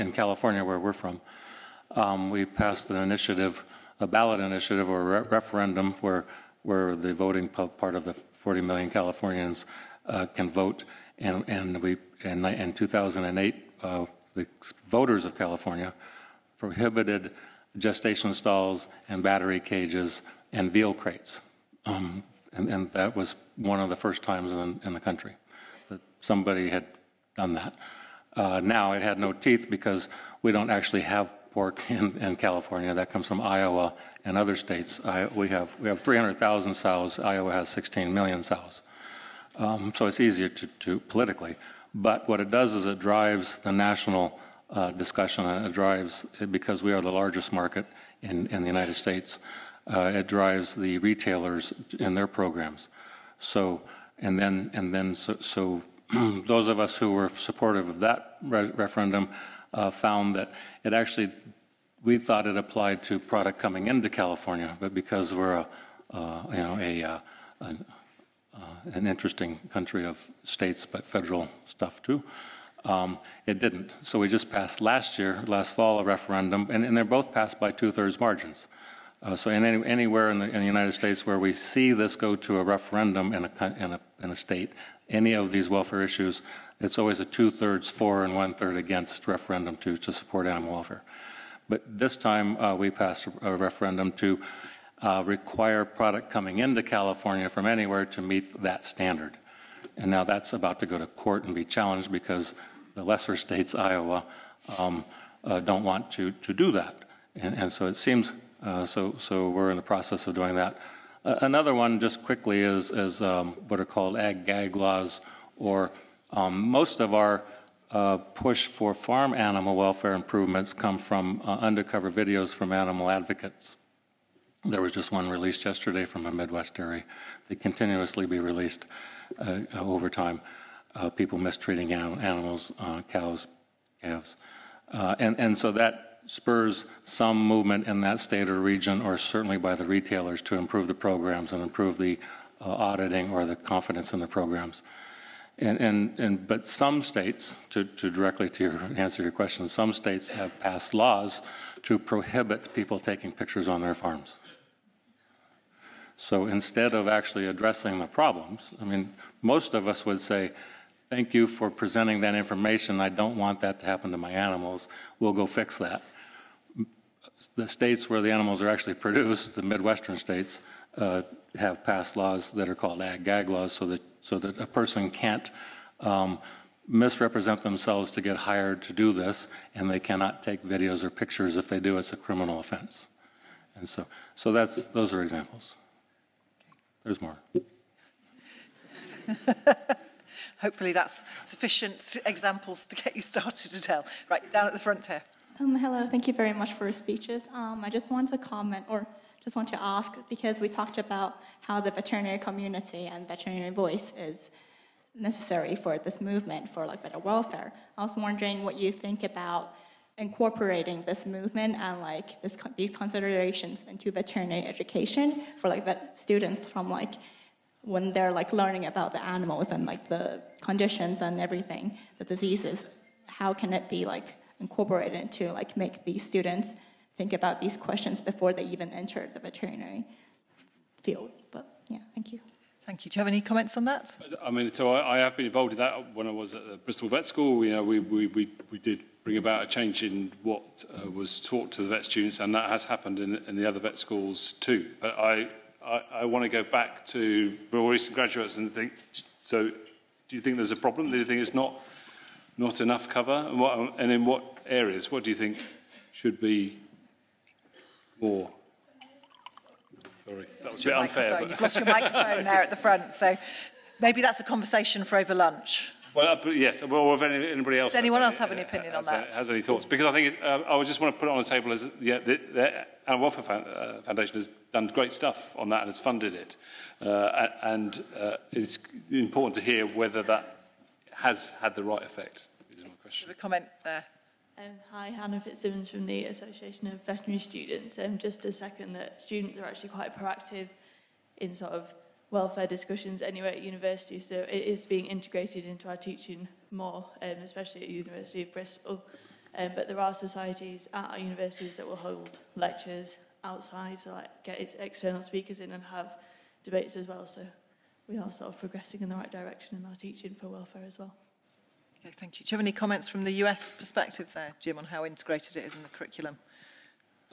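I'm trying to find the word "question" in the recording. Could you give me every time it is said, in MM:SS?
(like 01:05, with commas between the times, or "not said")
02:29, 03:47, 04:43.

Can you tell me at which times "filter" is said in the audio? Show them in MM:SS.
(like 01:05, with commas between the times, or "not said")
not said.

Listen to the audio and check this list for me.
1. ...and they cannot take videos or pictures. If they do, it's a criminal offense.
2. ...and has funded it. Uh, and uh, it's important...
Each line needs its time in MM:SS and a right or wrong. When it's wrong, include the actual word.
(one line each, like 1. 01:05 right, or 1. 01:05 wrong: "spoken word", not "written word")
1. 02:59 right
2. 04:35 right.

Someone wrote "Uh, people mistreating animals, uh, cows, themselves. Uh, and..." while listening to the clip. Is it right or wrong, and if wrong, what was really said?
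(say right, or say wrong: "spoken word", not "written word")
wrong: "calves", not "themselves".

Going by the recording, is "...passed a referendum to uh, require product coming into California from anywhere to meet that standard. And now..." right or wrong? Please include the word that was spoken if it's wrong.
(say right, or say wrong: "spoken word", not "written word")
right.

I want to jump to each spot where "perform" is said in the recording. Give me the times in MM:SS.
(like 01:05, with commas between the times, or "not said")
not said.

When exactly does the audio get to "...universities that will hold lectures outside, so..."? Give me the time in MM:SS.
05:01.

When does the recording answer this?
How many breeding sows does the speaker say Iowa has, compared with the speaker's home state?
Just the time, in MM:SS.
00:37.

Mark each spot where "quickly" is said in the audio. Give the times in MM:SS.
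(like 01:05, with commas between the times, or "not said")
01:52.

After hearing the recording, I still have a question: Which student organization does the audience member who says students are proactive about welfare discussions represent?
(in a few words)
Association of Veterinary Students.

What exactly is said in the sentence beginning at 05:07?
So we are sort of progressing in the right direction in our teaching for welfare as well.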